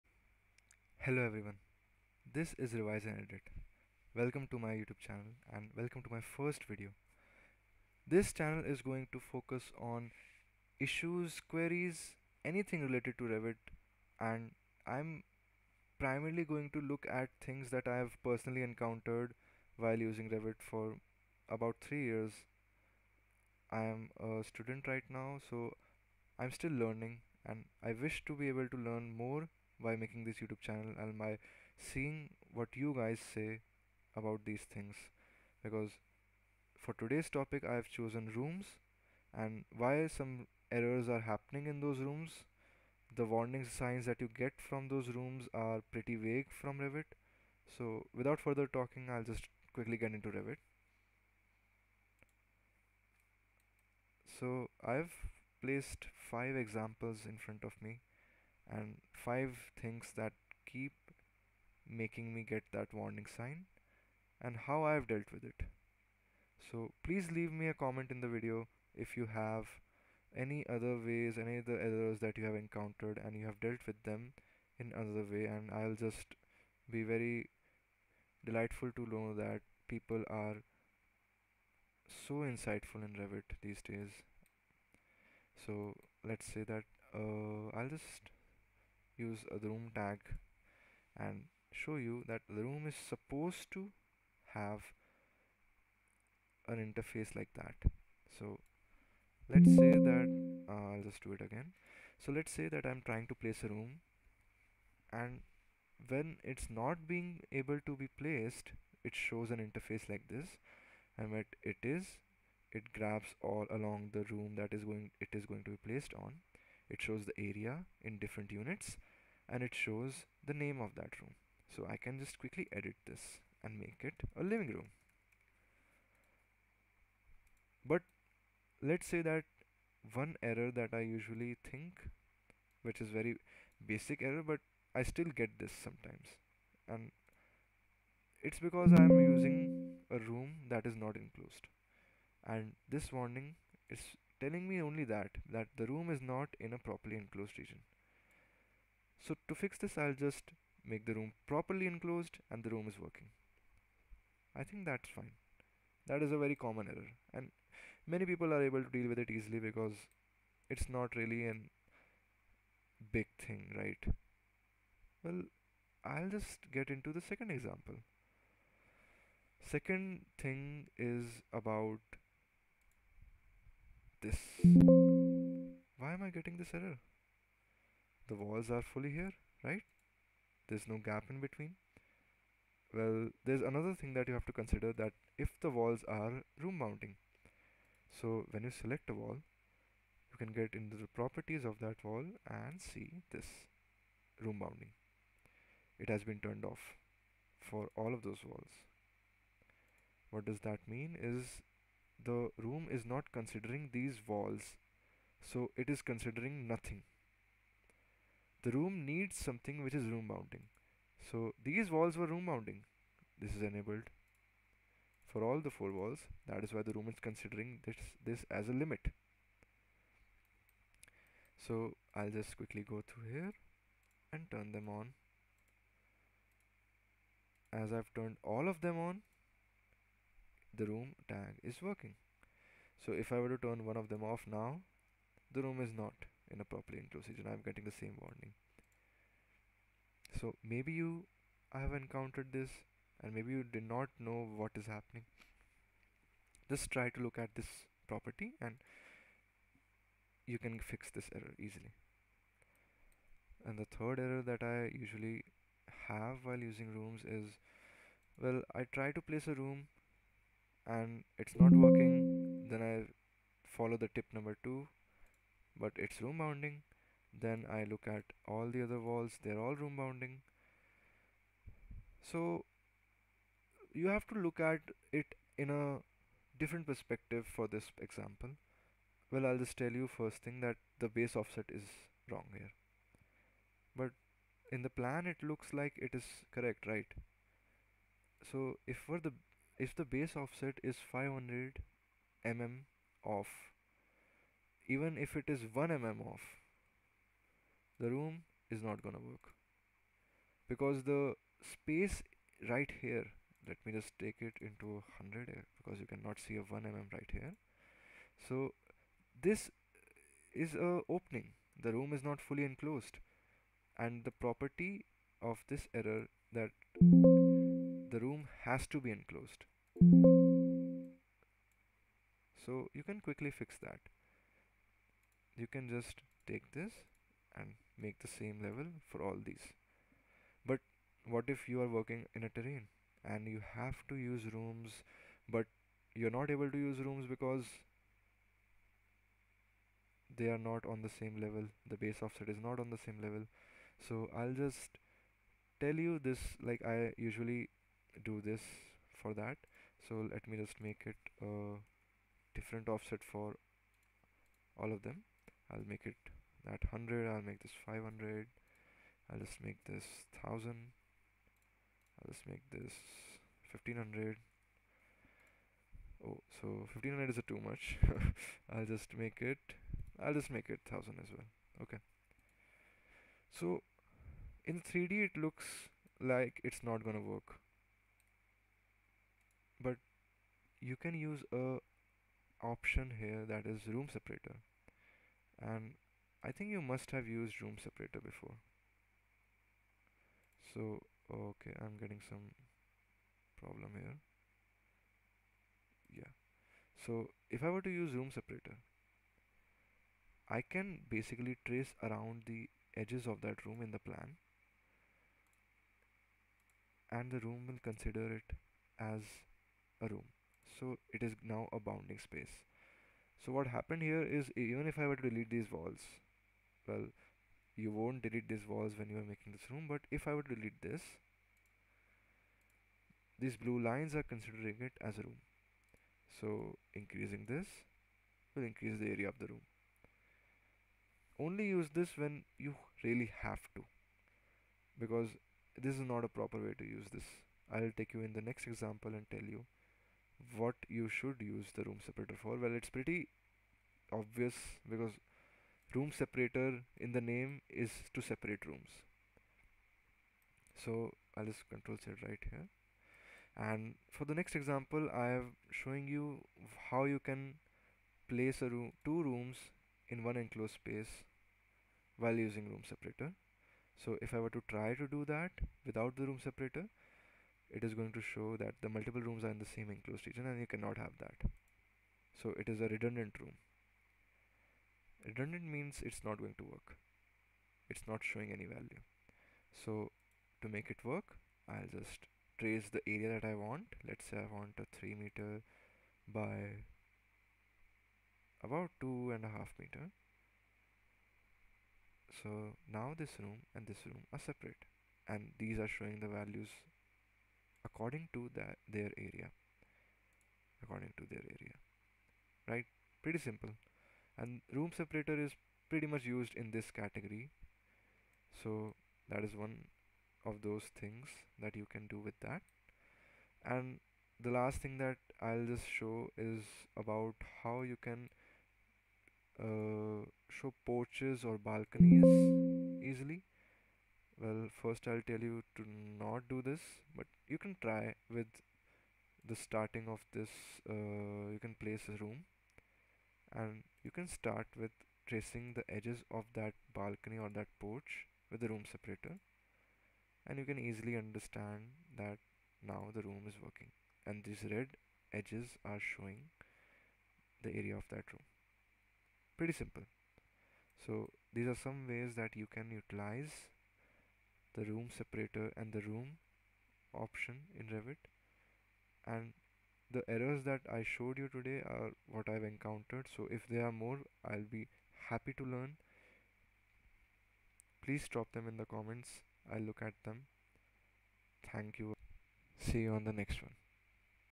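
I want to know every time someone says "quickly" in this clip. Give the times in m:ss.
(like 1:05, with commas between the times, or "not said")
0:49, 2:02, 3:42, 5:23.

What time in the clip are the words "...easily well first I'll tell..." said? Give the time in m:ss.
8:43.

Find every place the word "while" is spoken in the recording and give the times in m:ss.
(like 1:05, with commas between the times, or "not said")
0:19, 4:16, 7:42.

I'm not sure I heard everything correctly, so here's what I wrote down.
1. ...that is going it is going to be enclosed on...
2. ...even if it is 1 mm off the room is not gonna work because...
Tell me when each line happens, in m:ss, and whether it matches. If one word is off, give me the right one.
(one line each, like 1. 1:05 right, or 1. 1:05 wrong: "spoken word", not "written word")
1. 1:54 wrong: "placed", not "enclosed"
2. 4:54 right.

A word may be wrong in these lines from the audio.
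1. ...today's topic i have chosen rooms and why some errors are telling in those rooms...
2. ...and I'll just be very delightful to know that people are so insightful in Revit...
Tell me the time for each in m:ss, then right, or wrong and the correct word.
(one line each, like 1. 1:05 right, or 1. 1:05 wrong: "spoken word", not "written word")
1. 0:37 wrong: "happening", not "telling"
2. 1:15 right.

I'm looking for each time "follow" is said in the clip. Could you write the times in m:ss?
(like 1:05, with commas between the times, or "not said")
4:23.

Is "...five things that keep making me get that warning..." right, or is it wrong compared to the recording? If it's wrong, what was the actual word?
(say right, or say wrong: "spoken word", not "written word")
right.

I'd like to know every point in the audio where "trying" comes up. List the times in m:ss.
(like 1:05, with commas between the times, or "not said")
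1:43.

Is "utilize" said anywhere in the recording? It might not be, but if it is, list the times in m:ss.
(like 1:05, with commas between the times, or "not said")
9:12.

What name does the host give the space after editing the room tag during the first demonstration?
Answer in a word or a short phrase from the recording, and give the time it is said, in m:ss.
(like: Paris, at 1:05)
living room, at 2:04.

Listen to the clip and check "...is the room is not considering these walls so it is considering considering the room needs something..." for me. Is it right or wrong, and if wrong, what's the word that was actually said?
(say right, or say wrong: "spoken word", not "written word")
wrong: "nothing", not "considering".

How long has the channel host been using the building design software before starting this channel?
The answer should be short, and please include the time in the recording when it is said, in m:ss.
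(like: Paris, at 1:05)
3 years, at 0:21.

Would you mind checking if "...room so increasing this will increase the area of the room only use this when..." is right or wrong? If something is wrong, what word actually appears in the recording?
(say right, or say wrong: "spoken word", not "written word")
right.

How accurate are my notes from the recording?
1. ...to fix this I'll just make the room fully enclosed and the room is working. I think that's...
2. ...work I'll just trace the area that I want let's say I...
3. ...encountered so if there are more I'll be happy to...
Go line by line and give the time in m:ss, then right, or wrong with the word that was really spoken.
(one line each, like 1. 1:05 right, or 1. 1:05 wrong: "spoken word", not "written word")
1. 2:29 wrong: "properly", not "fully"
2. 8:01 right
3. 9:22 right.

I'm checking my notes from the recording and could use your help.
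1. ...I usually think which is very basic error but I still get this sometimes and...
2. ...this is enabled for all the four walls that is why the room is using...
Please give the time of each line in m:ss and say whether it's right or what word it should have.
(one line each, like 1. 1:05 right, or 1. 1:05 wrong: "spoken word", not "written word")
1. 2:10 right
2. 3:33 wrong: "considering", not "using".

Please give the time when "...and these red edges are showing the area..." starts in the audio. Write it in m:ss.
9:04.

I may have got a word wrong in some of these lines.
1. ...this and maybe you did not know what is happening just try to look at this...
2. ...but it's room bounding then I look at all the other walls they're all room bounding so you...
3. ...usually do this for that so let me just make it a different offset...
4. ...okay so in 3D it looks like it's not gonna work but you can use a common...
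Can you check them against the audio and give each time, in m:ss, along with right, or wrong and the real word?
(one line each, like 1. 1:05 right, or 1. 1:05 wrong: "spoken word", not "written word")
1. 4:02 right
2. 4:25 right
3. 5:47 right
4. 6:11 wrong: "option", not "common".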